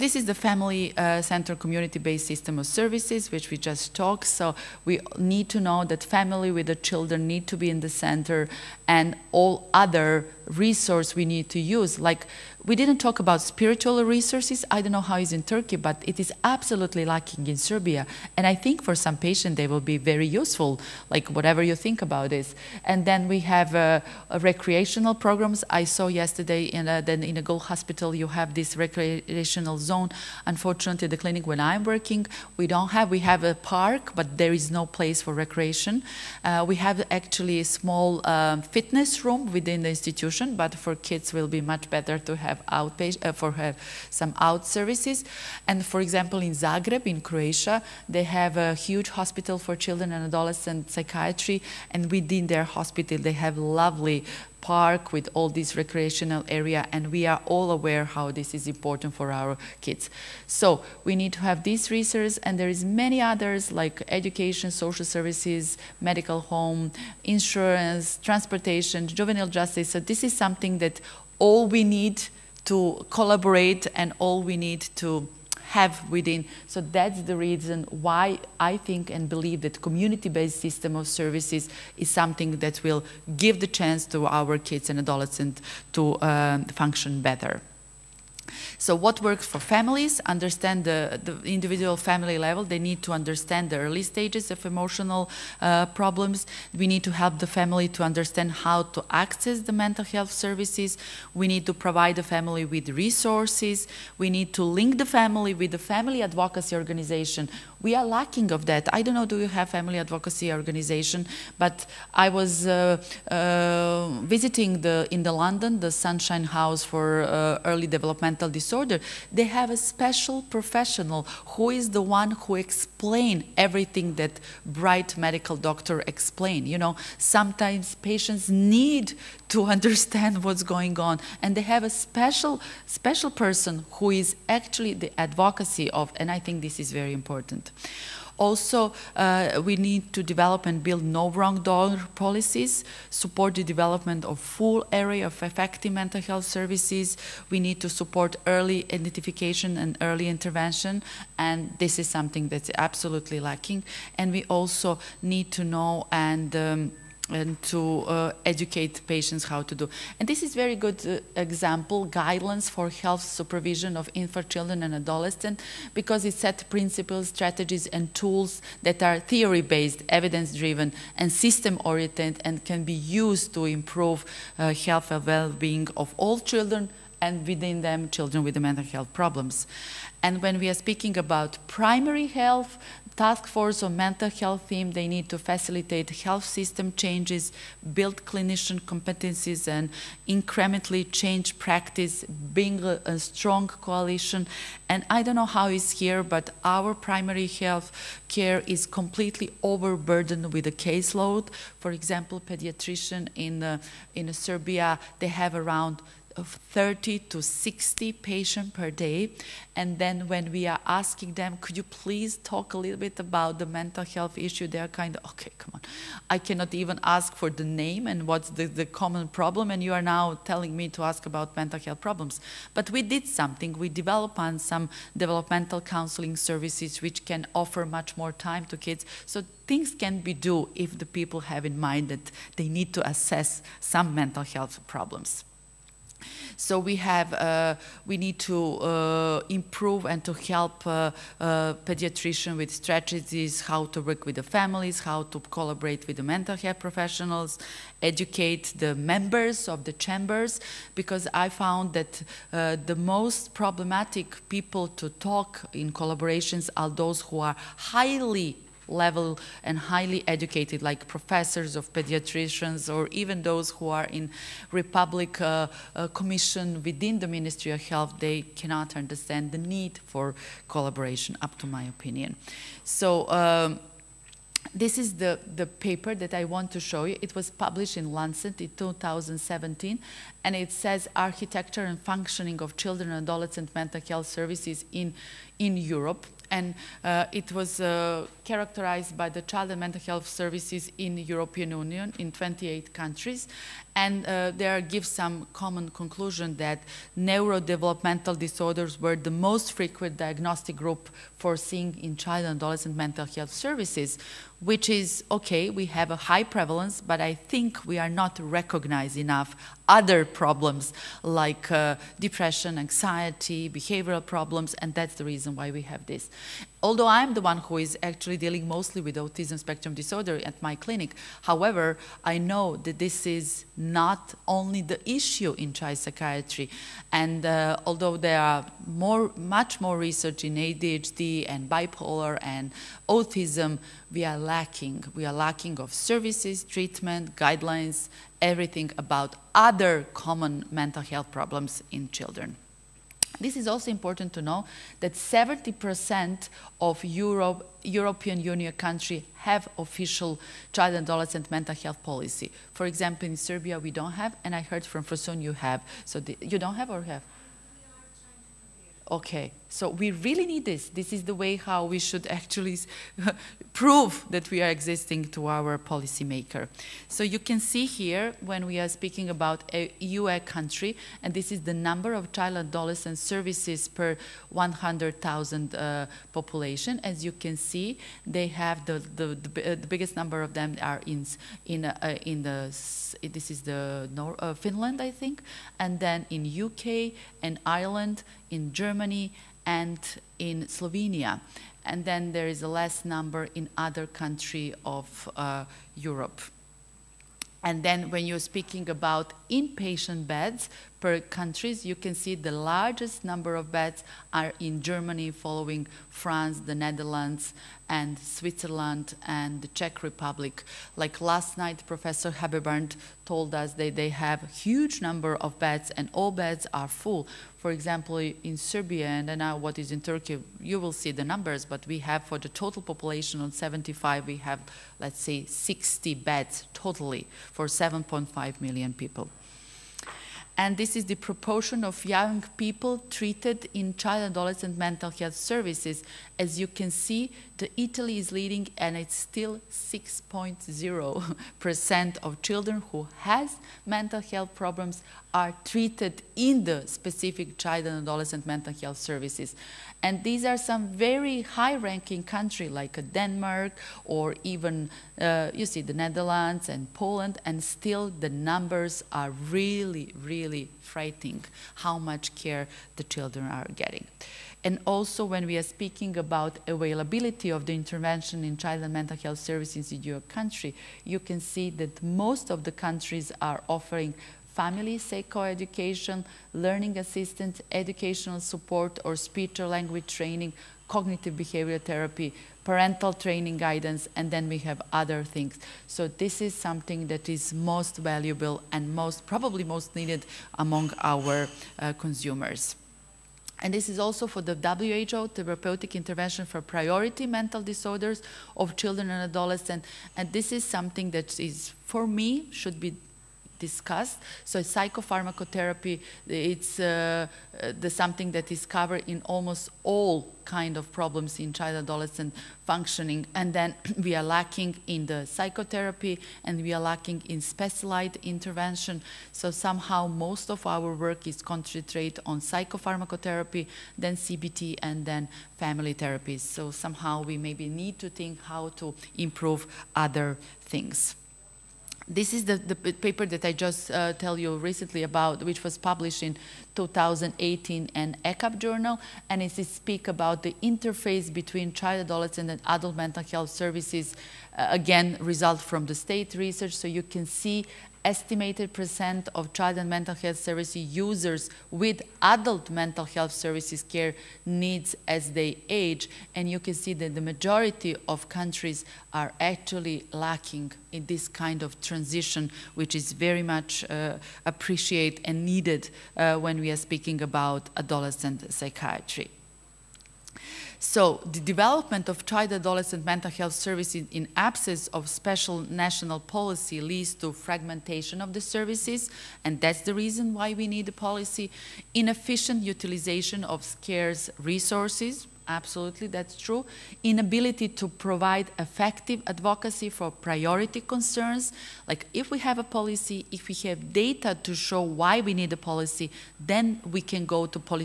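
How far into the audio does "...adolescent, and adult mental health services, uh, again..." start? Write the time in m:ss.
9:02.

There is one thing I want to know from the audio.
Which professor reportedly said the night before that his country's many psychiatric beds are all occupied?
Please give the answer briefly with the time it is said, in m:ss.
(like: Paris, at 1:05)
Professor Hebebrand, at 6:51.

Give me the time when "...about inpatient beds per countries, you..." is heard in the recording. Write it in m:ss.
6:38.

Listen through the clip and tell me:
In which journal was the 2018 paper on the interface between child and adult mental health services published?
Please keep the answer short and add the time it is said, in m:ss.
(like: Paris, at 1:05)
ECAP, at 8:58.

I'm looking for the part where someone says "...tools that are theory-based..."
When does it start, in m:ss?
2:48.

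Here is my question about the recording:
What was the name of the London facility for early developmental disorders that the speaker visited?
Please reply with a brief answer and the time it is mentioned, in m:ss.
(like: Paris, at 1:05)
Sunshine House, at 1:55.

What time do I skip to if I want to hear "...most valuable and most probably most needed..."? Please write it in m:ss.
8:07.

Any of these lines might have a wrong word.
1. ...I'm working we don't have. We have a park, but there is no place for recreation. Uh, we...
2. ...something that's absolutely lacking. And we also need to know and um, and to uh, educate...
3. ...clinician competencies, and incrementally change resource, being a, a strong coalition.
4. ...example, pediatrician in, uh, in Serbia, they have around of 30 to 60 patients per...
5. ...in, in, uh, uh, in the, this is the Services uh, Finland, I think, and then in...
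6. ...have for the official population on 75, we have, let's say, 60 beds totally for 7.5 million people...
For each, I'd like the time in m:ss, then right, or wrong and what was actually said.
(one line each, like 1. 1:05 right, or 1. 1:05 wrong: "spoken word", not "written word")
1. 0:31 right
2. 2:32 right
3. 3:08 wrong: "practice", not "resource"
4. 3:21 right
5. 6:21 wrong: "Nor", not "Services"
6. 7:01 wrong: "total", not "official".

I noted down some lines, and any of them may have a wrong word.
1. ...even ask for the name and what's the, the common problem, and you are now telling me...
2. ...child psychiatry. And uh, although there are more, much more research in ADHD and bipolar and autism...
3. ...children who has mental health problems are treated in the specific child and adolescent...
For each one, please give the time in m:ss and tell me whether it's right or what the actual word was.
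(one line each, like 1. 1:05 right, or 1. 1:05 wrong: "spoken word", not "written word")
1. 3:36 right
2. 5:25 right
3. 7:22 right.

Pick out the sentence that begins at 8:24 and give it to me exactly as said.
So psychopharmacotherapy, it's uh, the something that is covered in almost all kind of problems in child adolescent functioning.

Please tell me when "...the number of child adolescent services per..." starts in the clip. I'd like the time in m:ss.
6:11.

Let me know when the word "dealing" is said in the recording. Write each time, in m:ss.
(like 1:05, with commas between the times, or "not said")
5:18.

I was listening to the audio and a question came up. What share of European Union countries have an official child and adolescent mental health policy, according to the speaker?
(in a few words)
70%.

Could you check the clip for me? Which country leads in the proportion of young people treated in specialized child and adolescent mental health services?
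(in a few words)
Italy.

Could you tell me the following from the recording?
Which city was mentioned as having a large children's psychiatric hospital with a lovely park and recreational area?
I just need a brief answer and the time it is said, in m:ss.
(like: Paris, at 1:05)
Zagreb, at 0:46.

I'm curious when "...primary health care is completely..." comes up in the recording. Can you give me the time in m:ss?
3:16.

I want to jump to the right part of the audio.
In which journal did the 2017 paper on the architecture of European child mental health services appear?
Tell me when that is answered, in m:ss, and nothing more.
4:38.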